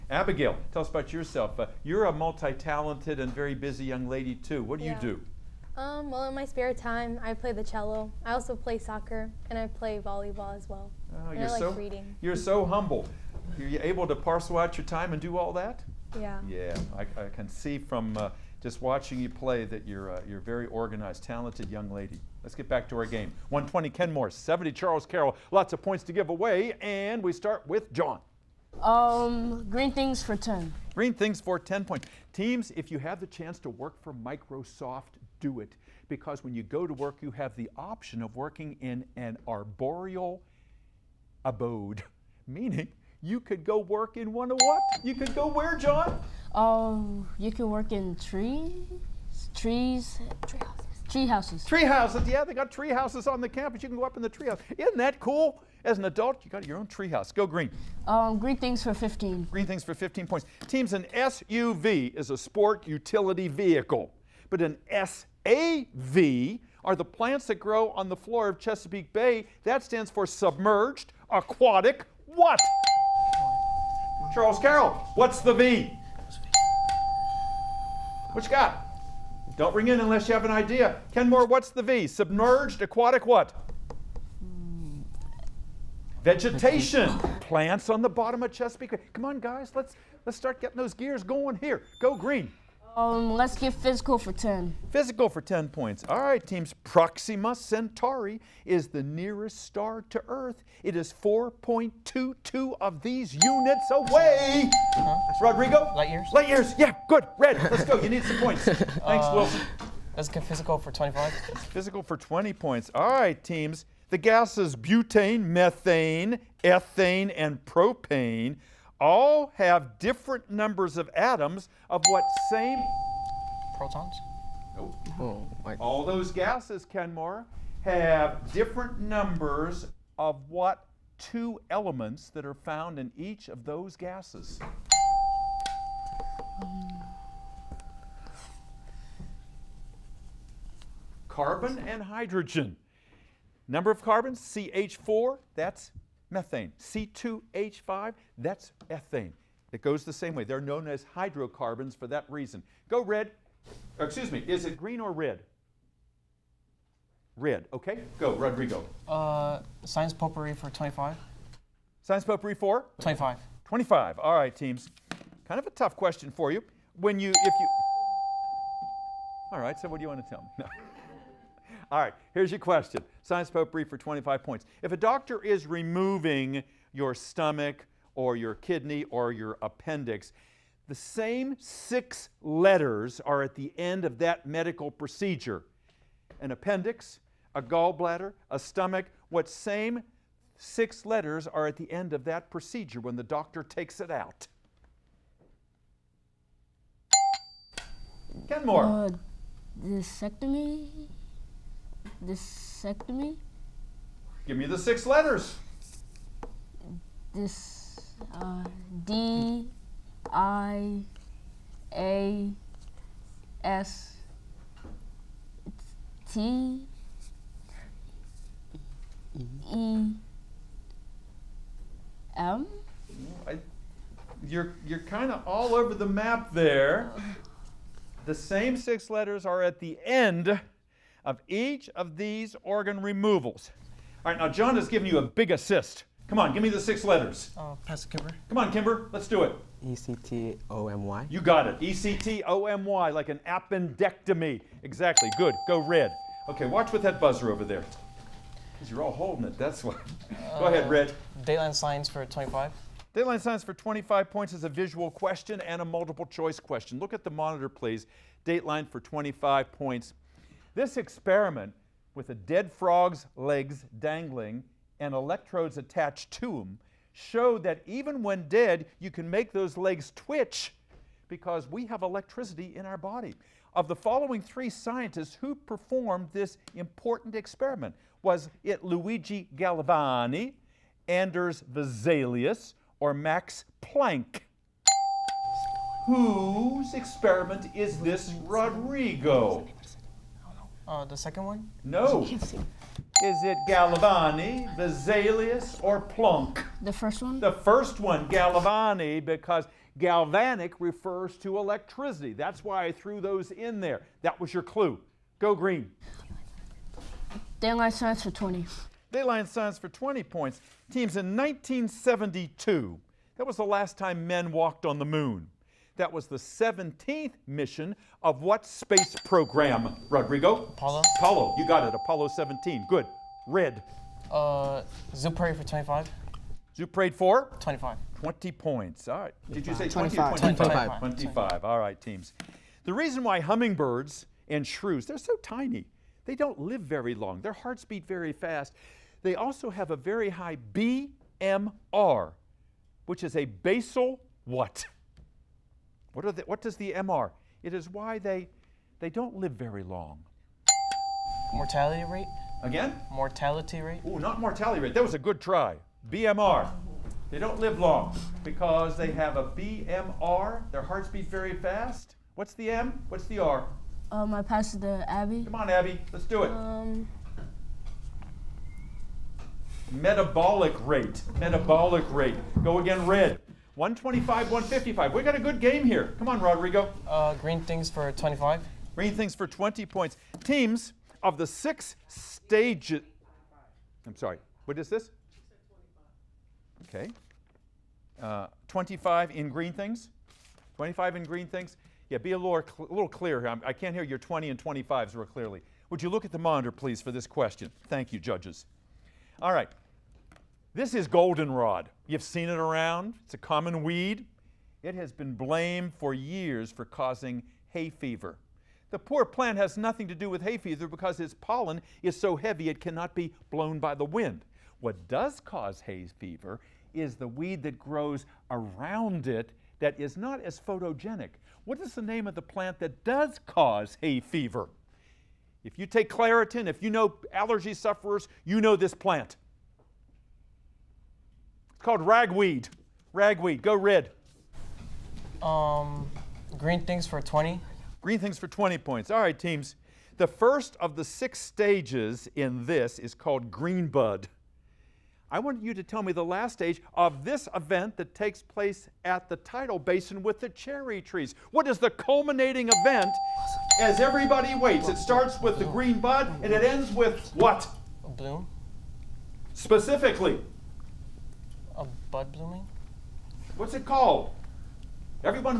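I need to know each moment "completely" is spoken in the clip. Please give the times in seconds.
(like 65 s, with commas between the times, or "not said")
not said.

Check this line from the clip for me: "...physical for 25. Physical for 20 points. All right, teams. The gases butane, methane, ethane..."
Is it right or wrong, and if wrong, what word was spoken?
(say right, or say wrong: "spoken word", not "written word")
right.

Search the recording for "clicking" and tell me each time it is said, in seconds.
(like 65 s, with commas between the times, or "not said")
not said.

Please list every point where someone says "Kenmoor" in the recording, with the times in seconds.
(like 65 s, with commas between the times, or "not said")
23 s, 81 s, 126 s, 198 s.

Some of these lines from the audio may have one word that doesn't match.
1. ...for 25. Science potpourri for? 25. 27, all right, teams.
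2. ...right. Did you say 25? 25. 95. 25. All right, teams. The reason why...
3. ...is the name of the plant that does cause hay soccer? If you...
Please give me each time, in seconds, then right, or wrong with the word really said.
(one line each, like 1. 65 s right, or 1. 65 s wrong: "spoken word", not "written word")
1. 160 s wrong: "25", not "27"
2. 329 s wrong: "25", not "95"
3. 421 s wrong: "fever", not "soccer".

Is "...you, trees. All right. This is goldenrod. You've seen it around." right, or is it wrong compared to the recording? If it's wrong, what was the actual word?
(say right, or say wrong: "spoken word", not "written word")
wrong: "judges", not "trees".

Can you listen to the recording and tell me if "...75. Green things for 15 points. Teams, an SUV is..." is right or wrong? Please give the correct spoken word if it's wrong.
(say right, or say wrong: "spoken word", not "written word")
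wrong: "15", not "75".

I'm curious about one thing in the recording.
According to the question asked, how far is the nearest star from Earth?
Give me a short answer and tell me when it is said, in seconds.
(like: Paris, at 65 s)
4.22, at 101 s.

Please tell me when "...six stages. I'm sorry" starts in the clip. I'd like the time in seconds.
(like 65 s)
381 s.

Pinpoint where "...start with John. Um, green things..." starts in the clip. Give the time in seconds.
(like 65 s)
27 s.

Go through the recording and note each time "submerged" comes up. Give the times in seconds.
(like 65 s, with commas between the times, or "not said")
70 s, 82 s.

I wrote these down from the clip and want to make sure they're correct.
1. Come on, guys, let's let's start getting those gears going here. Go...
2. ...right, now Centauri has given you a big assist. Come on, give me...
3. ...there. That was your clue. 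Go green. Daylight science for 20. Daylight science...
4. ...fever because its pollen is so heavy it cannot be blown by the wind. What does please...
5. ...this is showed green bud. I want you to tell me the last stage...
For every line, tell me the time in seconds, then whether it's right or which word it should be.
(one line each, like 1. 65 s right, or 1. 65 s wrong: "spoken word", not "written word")
1. 89 s right
2. 234 s wrong: "John", not "Centauri"
3. 303 s right
4. 410 s wrong: "cause", not "please"
5. 442 s wrong: "called", not "showed".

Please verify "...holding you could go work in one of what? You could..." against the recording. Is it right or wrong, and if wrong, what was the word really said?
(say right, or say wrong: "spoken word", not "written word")
wrong: "meaning", not "holding".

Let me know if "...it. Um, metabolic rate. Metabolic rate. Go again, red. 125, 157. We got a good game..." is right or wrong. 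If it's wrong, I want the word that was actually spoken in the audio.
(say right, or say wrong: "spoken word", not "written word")
wrong: "155", not "157".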